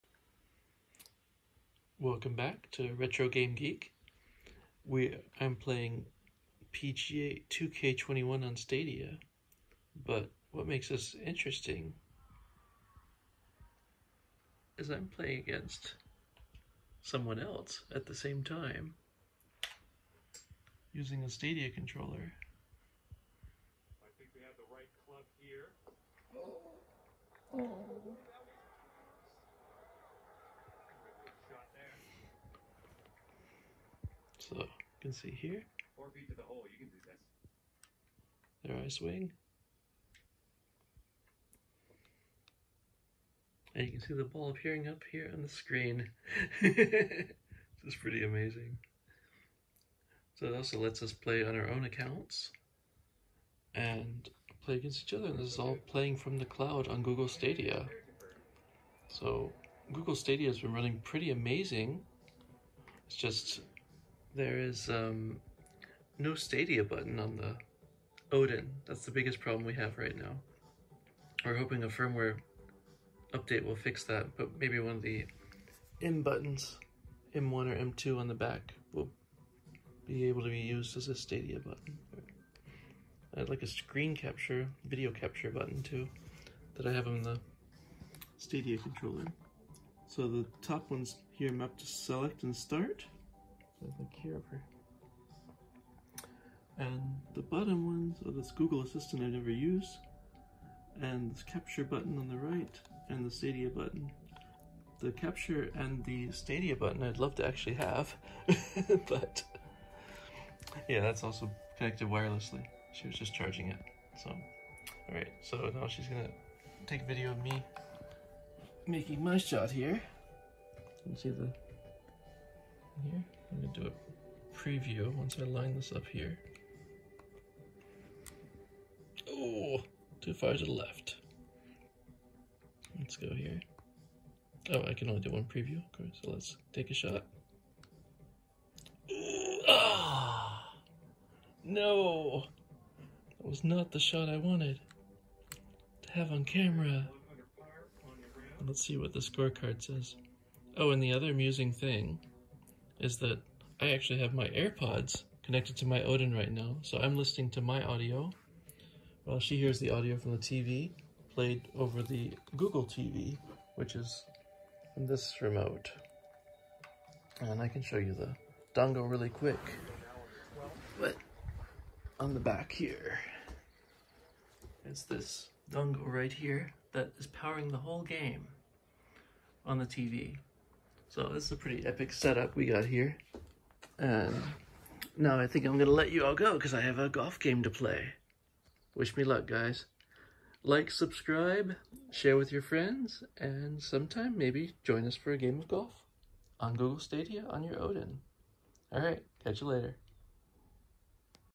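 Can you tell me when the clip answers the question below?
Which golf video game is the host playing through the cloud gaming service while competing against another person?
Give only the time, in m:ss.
0:06.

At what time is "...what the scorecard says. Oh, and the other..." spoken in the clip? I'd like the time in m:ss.
2:28.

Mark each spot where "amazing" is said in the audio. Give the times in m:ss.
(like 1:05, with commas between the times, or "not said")
0:48, 1:01.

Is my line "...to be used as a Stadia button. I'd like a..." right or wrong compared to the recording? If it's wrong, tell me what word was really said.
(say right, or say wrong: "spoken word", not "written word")
right.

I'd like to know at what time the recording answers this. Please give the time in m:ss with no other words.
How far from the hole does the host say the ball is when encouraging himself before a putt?
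0:35.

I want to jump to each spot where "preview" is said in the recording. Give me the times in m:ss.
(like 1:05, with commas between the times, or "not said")
2:04, 2:15.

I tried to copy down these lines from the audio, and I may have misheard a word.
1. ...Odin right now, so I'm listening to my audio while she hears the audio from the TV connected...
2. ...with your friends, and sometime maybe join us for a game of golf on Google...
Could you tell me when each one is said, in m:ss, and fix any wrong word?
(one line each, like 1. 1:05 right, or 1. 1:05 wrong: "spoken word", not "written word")
1. 2:36 wrong: "played", not "connected"
2. 3:12 right.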